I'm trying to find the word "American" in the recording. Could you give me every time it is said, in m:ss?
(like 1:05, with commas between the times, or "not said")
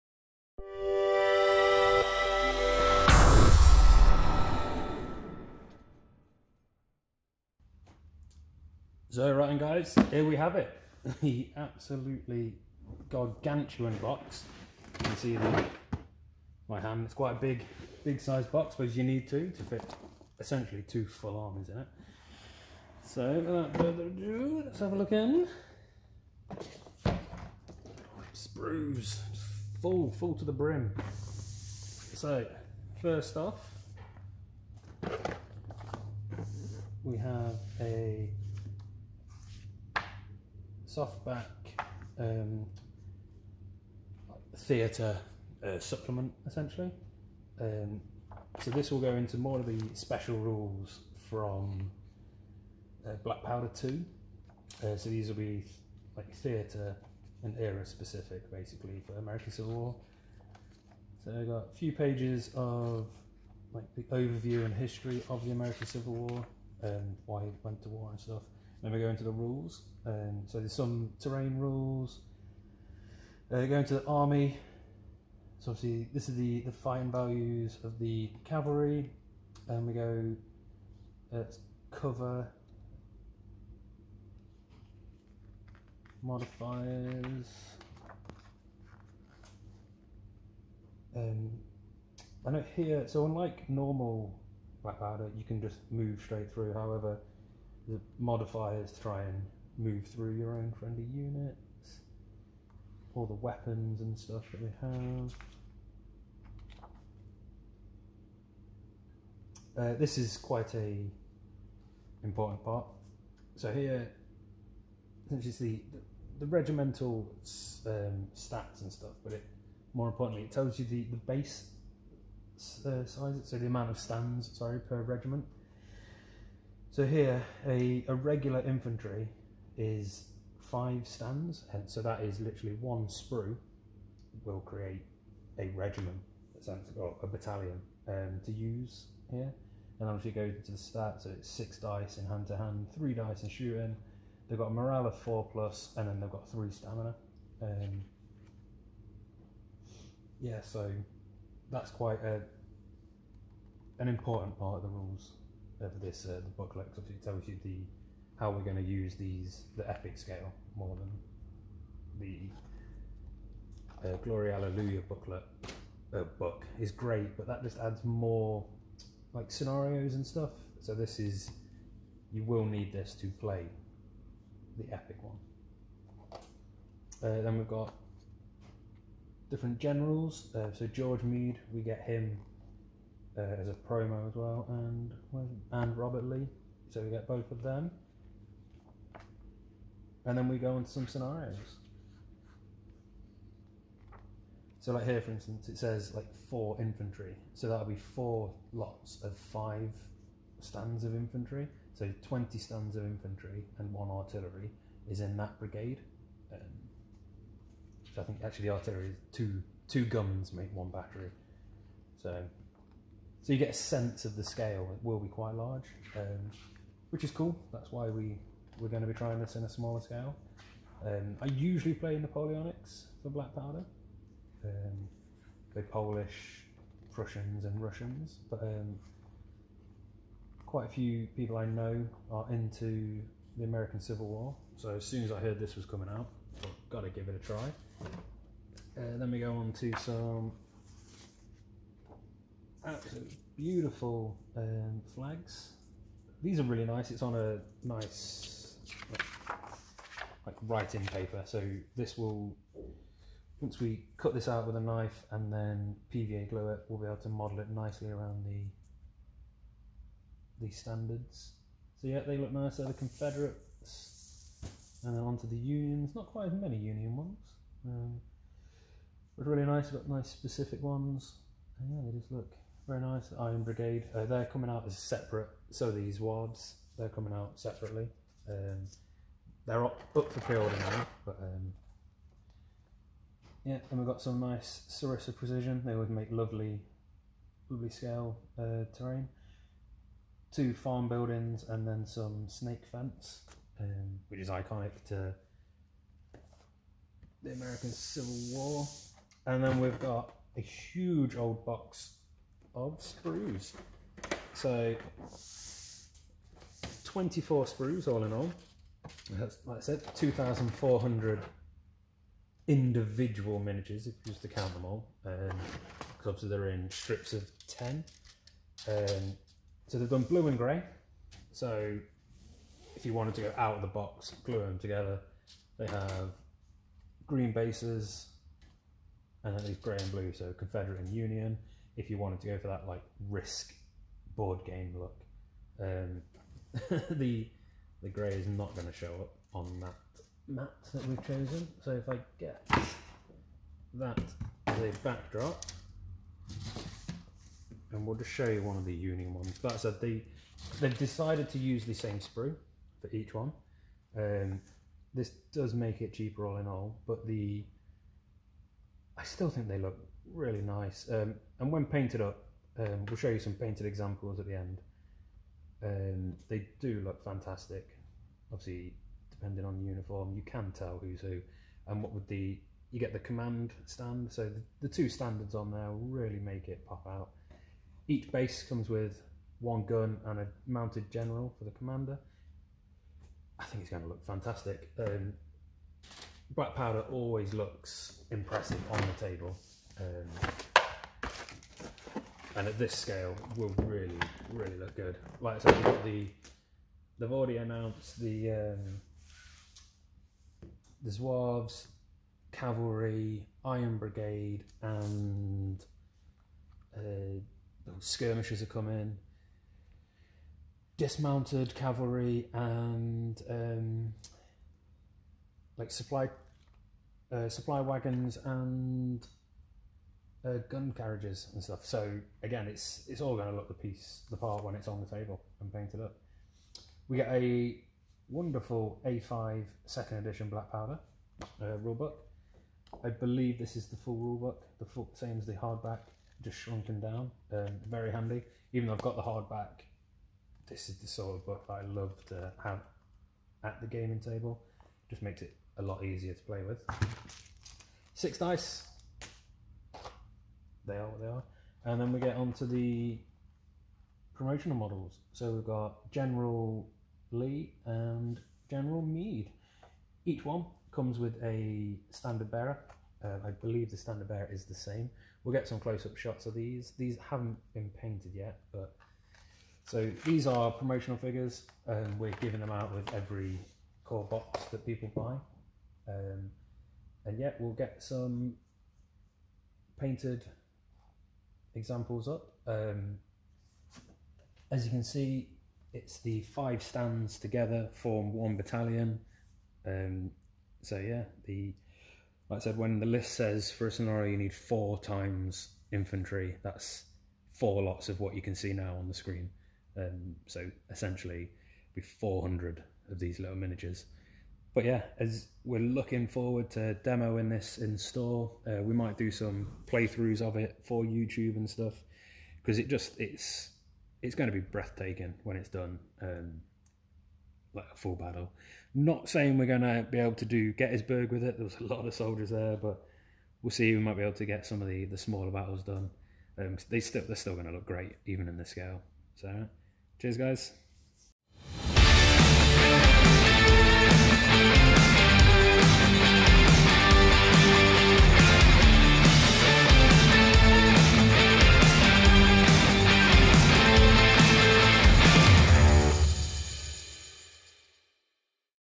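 0:59, 1:05, 3:53, 4:57.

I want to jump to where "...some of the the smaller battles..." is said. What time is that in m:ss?
8:44.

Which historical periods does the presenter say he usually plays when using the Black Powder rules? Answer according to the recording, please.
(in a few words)
Napoleonics.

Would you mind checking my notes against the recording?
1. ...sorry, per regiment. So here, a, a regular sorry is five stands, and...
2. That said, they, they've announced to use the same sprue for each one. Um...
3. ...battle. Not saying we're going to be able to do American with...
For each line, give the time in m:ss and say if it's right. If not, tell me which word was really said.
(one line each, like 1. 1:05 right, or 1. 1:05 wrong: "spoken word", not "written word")
1. 2:04 wrong: "infantry", not "sorry"
2. 5:49 wrong: "decided", not "announced"
3. 8:38 wrong: "Gettysburg", not "American".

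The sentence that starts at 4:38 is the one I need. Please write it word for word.
Um, they're up, up for pre-order now, but um, yeah.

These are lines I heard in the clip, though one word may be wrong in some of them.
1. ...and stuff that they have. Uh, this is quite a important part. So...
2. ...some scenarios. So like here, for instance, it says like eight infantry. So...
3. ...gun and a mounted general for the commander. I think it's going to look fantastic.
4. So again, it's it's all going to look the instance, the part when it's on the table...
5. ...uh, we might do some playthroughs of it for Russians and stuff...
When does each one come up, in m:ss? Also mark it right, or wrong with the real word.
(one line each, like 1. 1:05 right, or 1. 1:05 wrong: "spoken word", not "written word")
1. 1:43 right
2. 3:10 wrong: "four", not "eight"
3. 6:19 right
4. 7:01 wrong: "piece", not "instance"
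5. 8:28 wrong: "YouTube", not "Russians".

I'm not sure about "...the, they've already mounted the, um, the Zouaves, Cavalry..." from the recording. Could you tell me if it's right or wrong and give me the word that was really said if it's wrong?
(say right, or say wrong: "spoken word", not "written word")
wrong: "announced", not "mounted".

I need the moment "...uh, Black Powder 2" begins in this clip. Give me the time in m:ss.
0:53.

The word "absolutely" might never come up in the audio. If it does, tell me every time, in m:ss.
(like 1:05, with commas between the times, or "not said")
0:11, 4:02.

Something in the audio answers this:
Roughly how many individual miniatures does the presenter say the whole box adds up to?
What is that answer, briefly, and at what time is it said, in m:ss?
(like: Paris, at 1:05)
2,400, at 5:10.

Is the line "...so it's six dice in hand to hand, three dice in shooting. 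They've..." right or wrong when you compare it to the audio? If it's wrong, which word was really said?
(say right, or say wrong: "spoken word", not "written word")
right.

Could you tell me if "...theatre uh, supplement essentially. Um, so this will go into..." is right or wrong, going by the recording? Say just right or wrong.
right.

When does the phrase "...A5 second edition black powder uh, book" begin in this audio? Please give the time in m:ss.
7:09.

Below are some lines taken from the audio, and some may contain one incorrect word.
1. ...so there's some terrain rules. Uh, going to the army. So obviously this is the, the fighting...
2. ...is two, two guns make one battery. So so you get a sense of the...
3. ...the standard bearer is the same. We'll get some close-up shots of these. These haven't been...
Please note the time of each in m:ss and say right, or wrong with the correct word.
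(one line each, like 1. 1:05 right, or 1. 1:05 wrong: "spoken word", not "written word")
1. 1:10 right
2. 3:29 right
3. 7:43 right.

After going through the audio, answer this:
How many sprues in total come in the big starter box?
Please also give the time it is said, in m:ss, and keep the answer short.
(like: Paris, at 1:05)
24, at 5:07.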